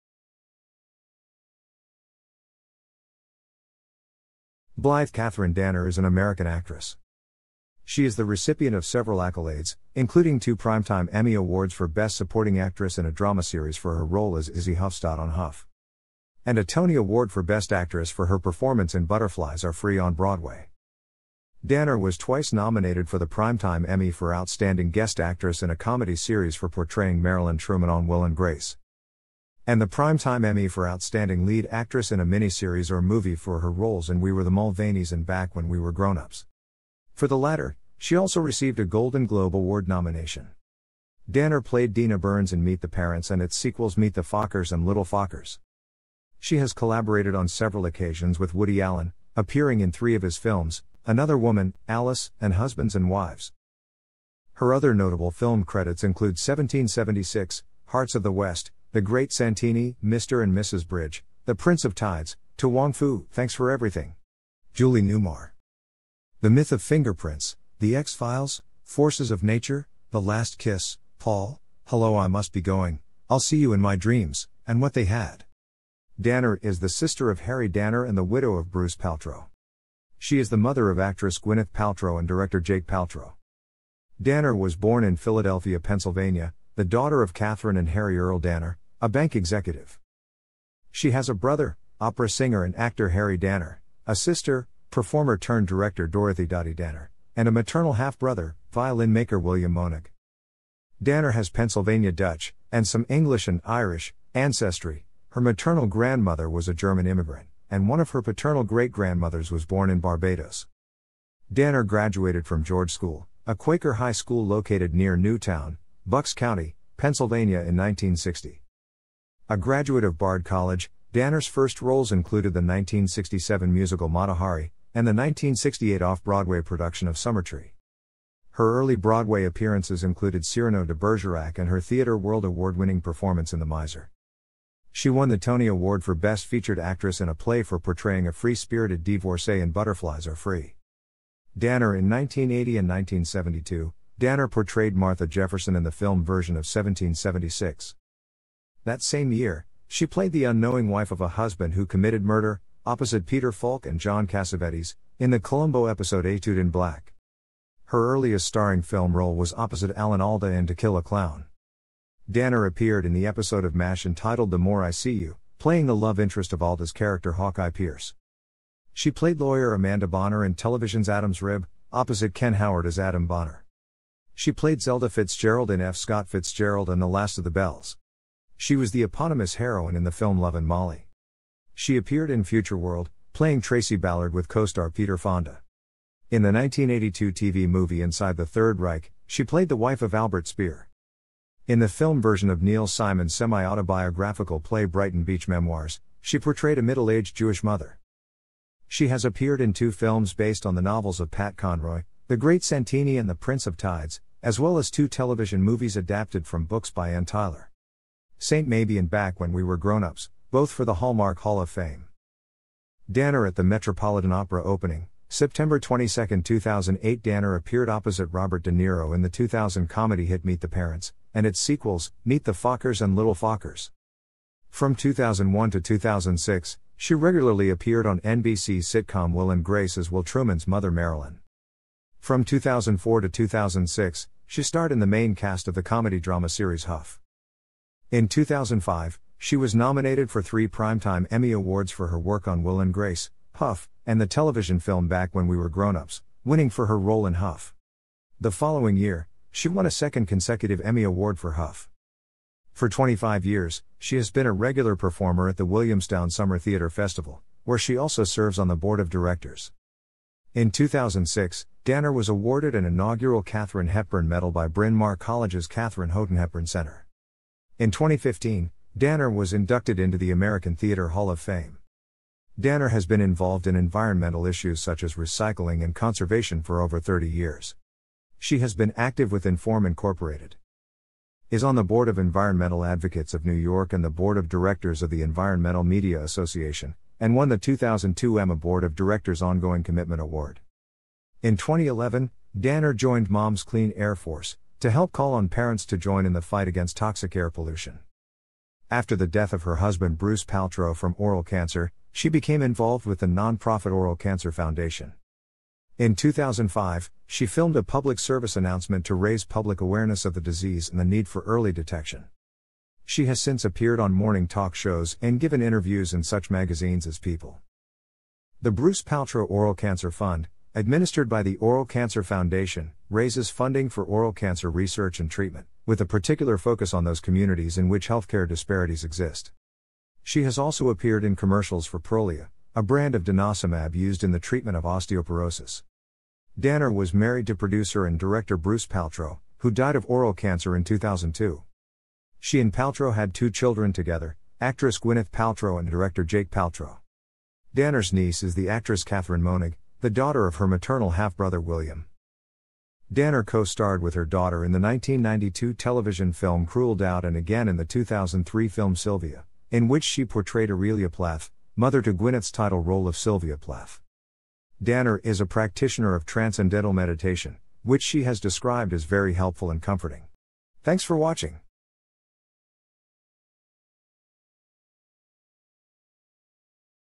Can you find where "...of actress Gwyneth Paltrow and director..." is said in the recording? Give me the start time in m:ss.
1:20.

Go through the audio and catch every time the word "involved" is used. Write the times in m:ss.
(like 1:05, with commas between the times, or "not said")
4:33, 5:02.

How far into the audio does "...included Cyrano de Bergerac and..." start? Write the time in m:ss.
2:10.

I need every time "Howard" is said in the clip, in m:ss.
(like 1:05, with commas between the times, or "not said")
2:52.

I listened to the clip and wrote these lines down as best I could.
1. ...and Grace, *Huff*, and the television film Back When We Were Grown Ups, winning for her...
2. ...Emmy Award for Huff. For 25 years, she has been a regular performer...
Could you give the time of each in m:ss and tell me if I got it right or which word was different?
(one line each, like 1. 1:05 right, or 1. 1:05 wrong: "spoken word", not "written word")
1. 4:02 right
2. 4:10 right.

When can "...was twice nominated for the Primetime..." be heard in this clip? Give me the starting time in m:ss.
0:21.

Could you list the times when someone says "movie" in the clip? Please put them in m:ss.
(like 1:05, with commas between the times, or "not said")
0:32, 3:07, 3:25.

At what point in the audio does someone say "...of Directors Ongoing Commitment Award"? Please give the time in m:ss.
4:48.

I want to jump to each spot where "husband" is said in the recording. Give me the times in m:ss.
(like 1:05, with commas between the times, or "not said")
0:52, 2:31, 4:59.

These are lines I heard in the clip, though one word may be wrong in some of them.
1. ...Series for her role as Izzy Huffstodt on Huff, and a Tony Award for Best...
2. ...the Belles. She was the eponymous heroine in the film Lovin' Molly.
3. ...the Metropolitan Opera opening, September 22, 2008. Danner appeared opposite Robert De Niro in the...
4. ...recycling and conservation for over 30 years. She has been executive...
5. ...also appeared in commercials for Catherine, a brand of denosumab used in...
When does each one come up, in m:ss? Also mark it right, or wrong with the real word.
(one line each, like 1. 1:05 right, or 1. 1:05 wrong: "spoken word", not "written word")
1. 0:13 right
2. 2:57 right
3. 3:33 right
4. 4:35 wrong: "active", not "executive"
5. 5:30 wrong: "Prolia", not "Catherine".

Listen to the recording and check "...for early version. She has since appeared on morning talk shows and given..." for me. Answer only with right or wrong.
wrong.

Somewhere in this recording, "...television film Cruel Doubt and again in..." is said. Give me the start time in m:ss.
5:55.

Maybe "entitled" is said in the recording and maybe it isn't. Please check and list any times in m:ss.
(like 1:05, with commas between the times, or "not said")
2:44.